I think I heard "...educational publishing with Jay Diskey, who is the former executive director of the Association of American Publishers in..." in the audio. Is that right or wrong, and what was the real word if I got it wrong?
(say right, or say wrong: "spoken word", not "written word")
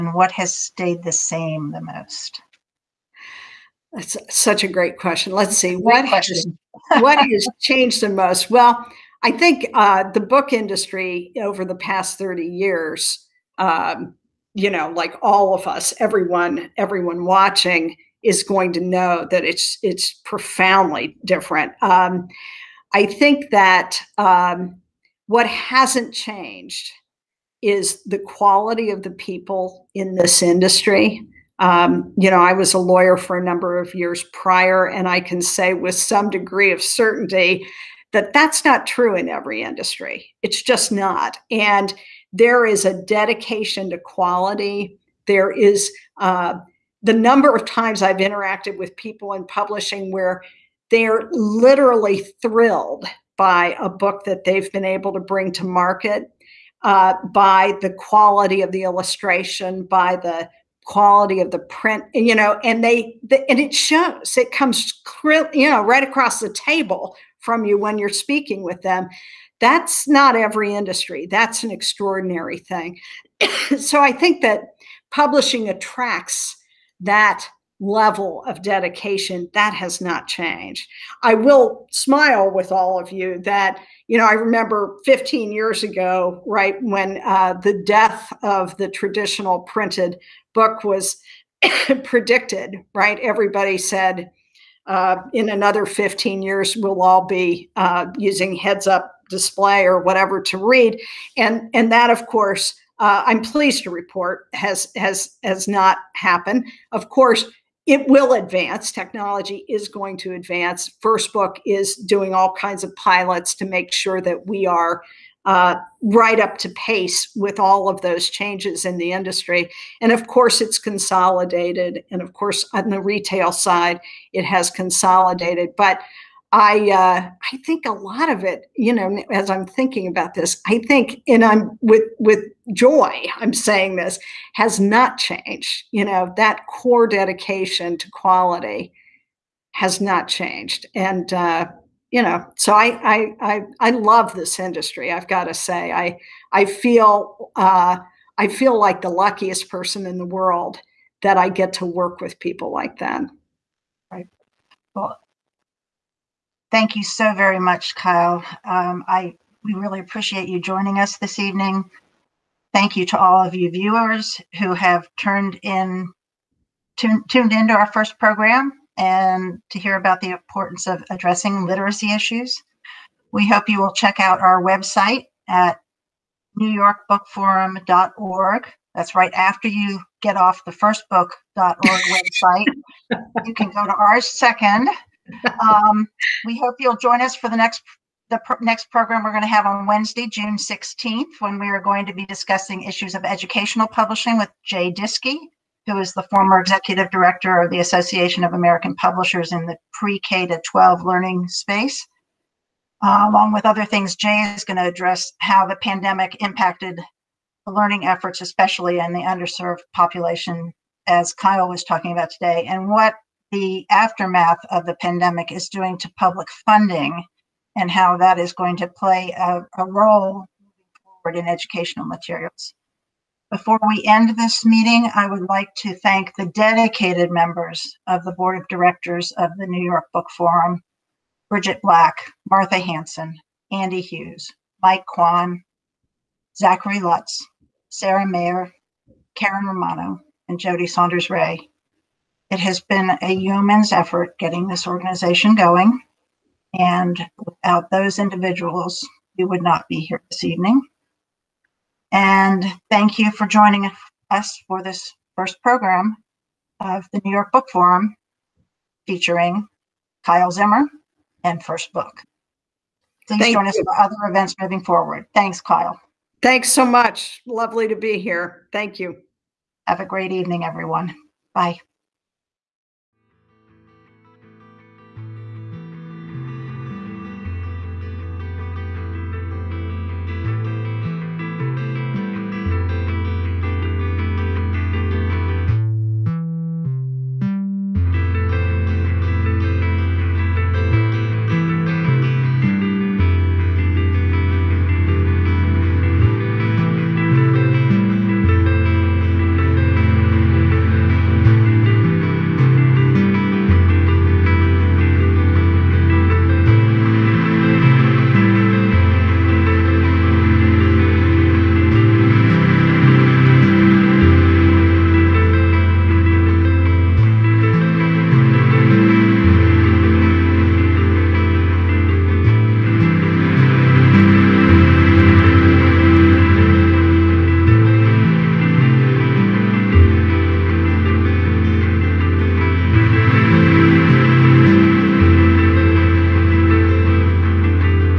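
right.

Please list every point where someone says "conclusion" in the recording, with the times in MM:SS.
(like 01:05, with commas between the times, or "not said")
not said.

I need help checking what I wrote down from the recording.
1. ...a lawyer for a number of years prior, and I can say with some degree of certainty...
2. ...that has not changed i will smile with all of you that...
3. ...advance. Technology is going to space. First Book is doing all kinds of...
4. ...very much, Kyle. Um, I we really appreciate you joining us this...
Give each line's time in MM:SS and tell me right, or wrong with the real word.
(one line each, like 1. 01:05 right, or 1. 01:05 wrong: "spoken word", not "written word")
1. 00:32 right
2. 01:19 right
3. 01:48 wrong: "advance", not "space"
4. 02:37 right.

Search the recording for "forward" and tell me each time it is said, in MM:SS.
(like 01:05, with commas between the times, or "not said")
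03:41, 04:24.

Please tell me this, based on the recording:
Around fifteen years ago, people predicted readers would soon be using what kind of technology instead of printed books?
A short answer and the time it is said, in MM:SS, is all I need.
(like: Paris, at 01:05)
Heads up display, at 01:38.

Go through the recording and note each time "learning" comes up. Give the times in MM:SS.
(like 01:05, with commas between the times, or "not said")
03:21, 03:27.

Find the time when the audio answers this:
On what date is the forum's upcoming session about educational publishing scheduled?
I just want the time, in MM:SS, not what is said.
03:09.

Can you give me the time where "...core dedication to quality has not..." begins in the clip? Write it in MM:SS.
02:16.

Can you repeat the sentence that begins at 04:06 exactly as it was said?
And without those individuals, we would not be here this evening.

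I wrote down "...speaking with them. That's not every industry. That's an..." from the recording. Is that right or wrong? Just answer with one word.
right.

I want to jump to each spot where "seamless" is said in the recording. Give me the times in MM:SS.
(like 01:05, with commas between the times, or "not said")
not said.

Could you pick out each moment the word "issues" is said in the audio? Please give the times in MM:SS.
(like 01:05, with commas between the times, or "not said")
02:52, 03:12.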